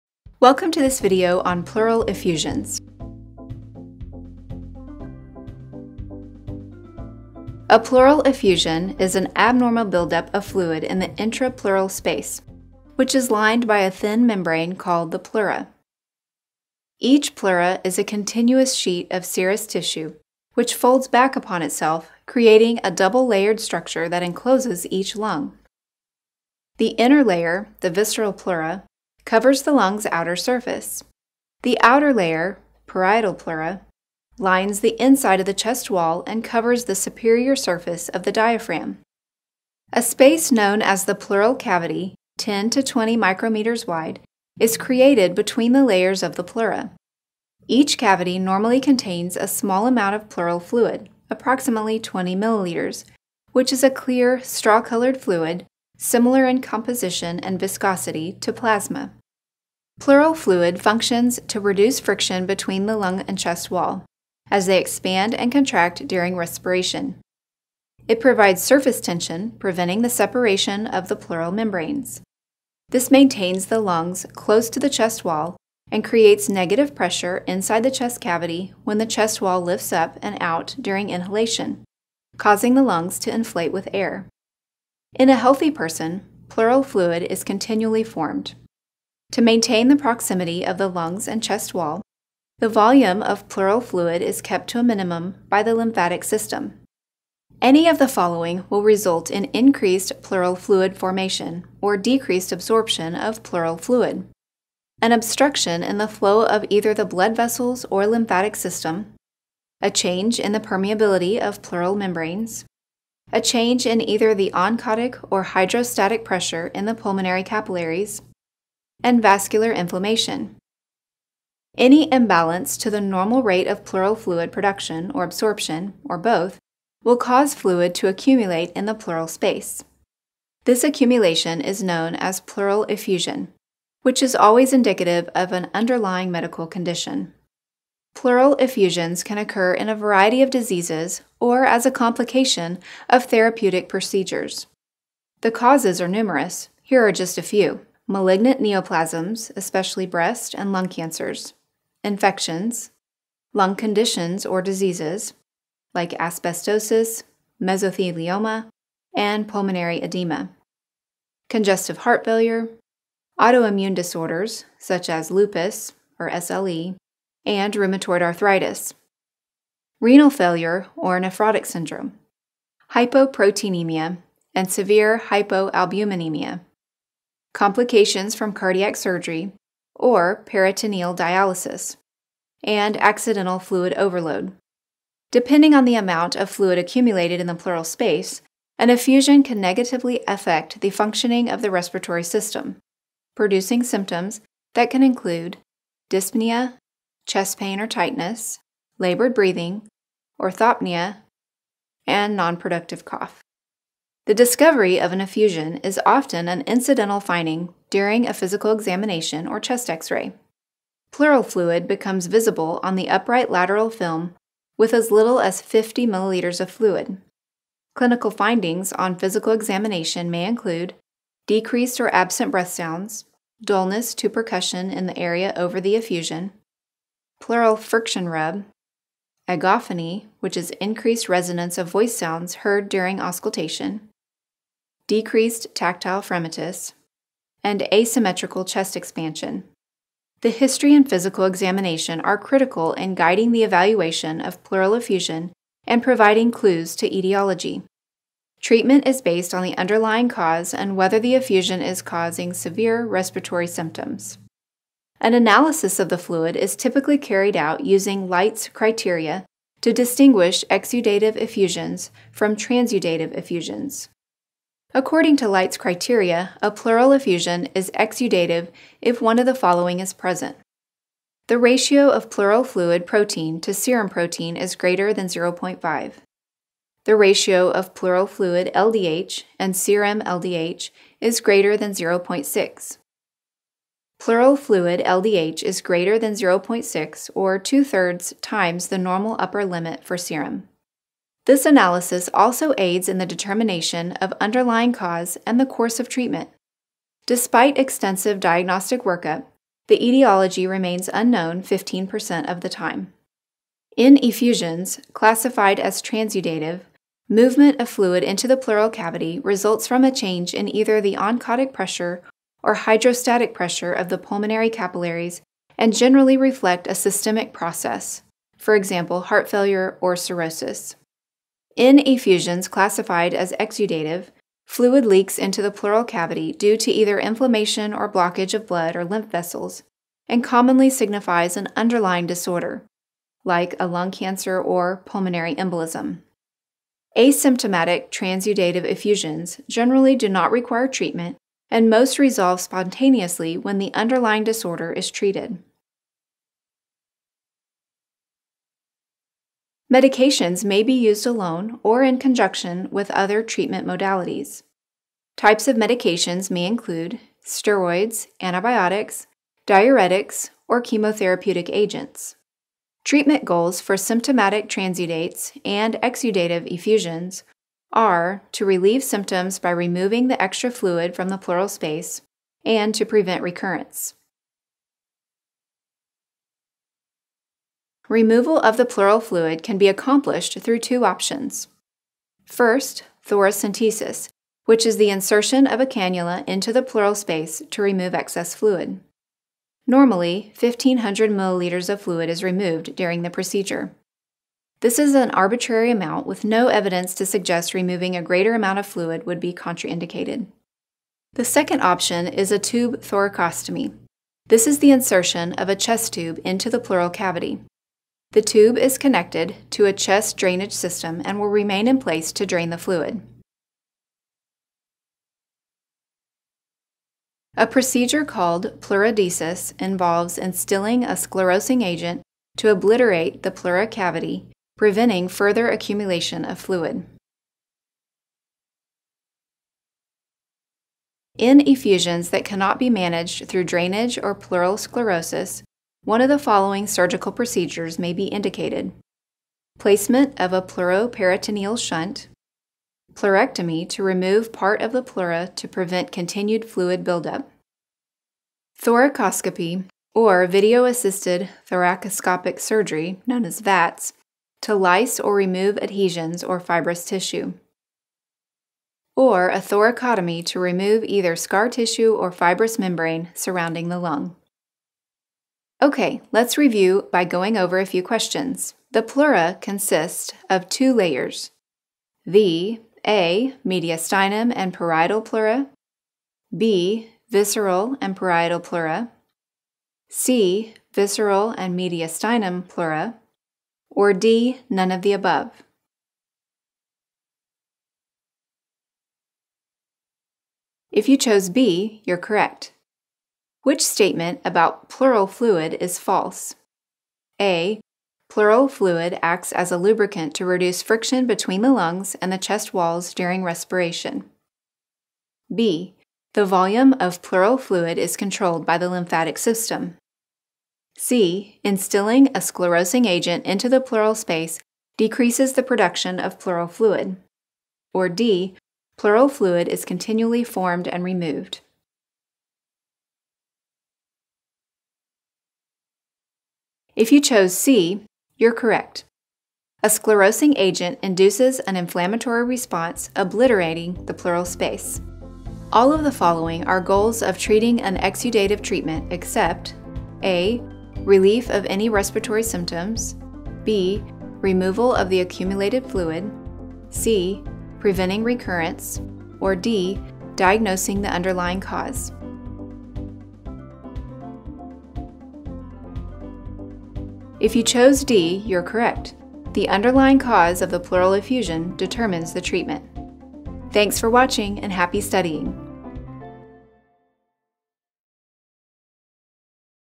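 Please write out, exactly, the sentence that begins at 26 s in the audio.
The inner layer, the visceral pleura, covers the lung's outer surface.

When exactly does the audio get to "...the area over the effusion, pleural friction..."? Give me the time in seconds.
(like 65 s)
225 s.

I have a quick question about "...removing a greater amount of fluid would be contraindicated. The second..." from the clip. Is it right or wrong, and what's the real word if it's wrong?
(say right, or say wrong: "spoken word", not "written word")
right.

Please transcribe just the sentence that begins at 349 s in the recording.
Medications may be used alone or in conjunction with other treatment modalities.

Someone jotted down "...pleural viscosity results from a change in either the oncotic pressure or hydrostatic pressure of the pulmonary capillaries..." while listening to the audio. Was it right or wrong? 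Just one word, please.
wrong.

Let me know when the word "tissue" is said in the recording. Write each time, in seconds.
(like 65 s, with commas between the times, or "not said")
19 s, 457 s, 461 s.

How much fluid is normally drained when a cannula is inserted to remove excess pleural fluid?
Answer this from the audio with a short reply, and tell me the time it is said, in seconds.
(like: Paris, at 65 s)
1500 milliliters, at 390 s.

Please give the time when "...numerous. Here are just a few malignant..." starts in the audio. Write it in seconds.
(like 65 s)
146 s.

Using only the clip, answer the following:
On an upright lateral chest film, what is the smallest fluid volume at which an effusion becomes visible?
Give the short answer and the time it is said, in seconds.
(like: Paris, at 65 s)
50 milliliters, at 215 s.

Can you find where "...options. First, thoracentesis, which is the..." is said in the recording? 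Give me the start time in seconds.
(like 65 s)
381 s.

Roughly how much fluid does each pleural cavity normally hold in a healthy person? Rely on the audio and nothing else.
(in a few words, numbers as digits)
20 milliliters.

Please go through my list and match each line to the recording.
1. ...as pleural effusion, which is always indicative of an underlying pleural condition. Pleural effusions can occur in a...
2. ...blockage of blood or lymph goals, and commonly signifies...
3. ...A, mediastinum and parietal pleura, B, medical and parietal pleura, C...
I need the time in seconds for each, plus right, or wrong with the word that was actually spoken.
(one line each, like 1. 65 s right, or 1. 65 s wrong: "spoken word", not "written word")
1. 132 s wrong: "medical", not "pleural"
2. 328 s wrong: "vessels", not "goals"
3. 473 s wrong: "visceral", not "medical".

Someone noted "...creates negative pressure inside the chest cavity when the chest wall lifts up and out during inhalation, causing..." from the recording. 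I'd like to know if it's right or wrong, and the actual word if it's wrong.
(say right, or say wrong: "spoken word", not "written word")
right.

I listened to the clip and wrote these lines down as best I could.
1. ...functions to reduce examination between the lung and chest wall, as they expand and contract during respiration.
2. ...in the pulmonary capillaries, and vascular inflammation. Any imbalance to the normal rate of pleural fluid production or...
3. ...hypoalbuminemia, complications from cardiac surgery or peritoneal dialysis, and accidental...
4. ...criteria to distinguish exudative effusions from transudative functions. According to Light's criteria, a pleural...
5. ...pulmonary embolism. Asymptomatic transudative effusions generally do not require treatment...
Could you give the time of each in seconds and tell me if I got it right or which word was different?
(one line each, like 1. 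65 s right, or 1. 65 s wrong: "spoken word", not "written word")
1. 60 s wrong: "friction", not "examination"
2. 116 s right
3. 175 s right
4. 258 s wrong: "effusions", not "functions"
5. 335 s right.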